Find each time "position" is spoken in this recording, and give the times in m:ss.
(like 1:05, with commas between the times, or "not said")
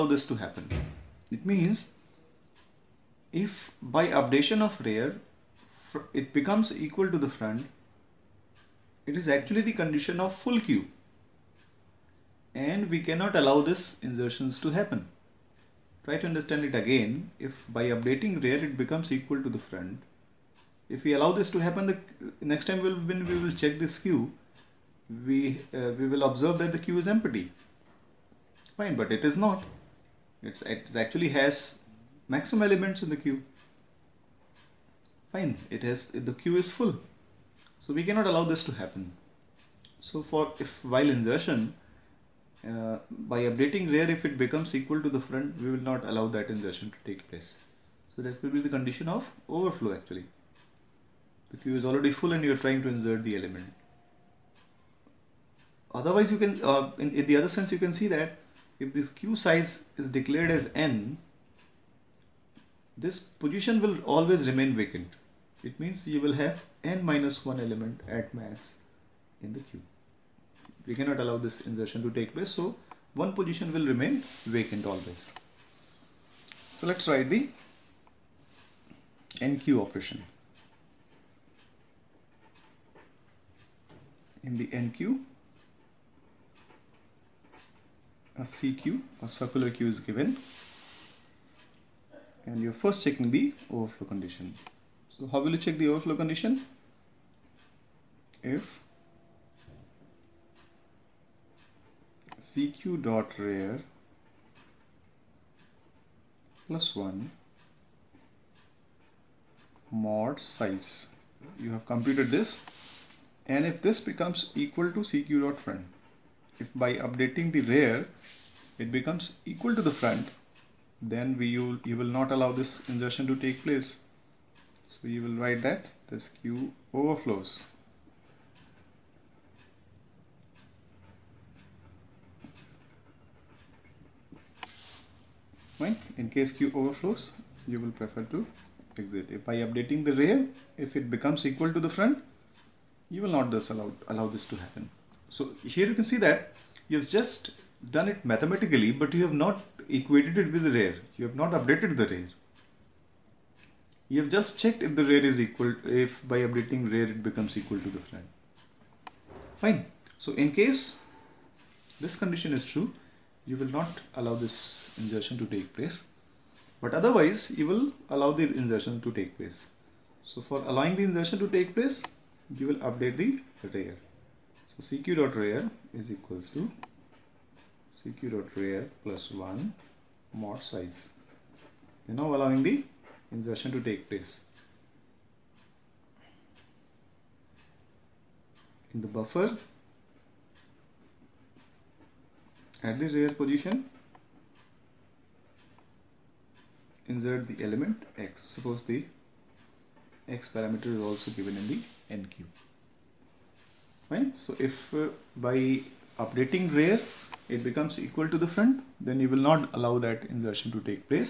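1:03, 1:13, 3:13.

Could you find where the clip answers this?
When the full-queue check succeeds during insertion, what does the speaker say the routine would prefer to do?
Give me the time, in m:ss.
2:18.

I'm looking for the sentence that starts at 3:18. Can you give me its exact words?
Suppose the x parameter is also given in the enqueue.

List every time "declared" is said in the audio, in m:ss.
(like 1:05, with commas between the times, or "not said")
1:00.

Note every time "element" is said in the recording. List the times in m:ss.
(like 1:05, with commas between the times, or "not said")
0:32, 0:53, 1:07, 3:17.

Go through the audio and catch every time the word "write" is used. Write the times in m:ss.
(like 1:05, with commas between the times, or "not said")
1:17, 2:05.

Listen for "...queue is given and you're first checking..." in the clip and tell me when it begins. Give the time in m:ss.
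1:29.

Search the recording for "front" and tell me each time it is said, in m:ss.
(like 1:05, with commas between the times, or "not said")
0:07, 0:19, 0:45, 1:55, 2:00, 2:21, 2:38, 3:28.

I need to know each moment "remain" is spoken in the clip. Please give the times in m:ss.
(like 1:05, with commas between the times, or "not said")
1:04, 1:13.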